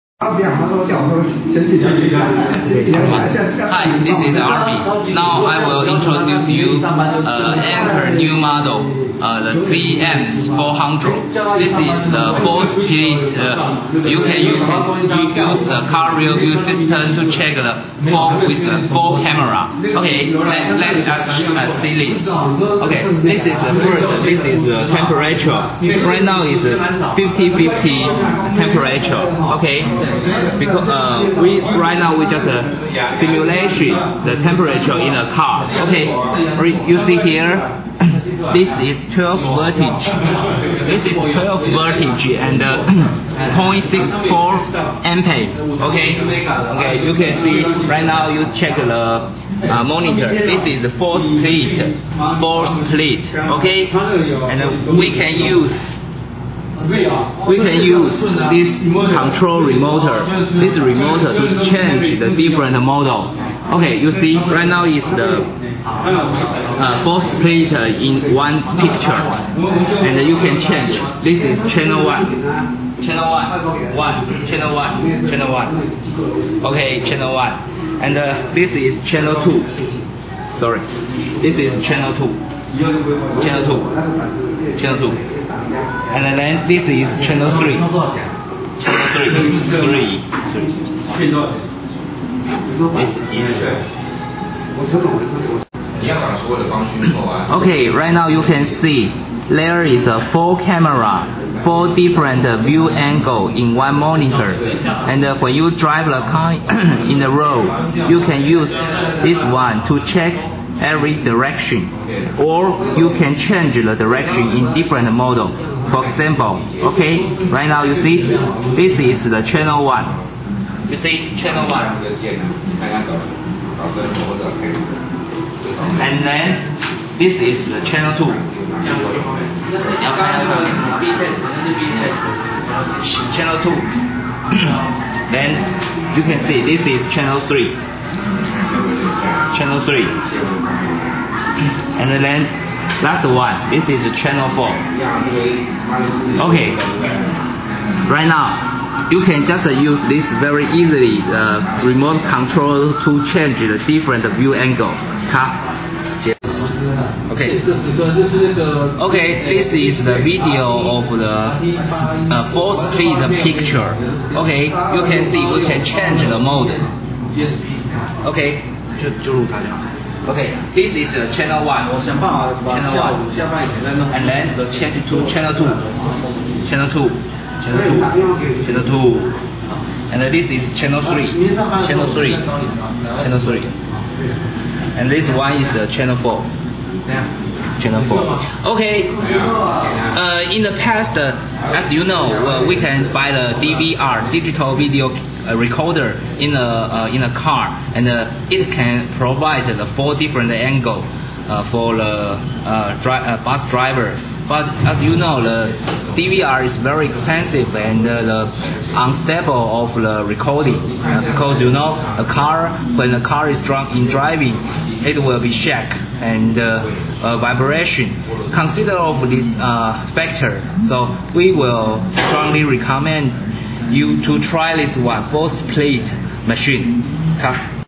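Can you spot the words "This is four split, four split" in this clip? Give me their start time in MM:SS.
00:50.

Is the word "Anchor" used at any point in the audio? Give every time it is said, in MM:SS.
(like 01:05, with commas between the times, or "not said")
00:07.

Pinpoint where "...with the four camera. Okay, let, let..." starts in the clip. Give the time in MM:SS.
00:18.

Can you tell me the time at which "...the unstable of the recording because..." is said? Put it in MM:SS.
03:28.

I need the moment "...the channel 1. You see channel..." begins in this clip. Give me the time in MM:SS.
01:59.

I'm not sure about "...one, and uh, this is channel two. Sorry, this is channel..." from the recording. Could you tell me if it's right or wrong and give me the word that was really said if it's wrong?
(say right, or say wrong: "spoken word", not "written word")
right.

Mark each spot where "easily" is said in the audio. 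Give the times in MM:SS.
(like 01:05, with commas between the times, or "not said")
02:30.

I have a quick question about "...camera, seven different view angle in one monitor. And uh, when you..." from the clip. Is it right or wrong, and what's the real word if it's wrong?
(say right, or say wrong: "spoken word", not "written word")
wrong: "four", not "seven".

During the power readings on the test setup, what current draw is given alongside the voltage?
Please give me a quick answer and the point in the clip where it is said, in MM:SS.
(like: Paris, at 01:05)
0.64 amperes, at 00:42.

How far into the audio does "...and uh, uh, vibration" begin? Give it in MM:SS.
03:36.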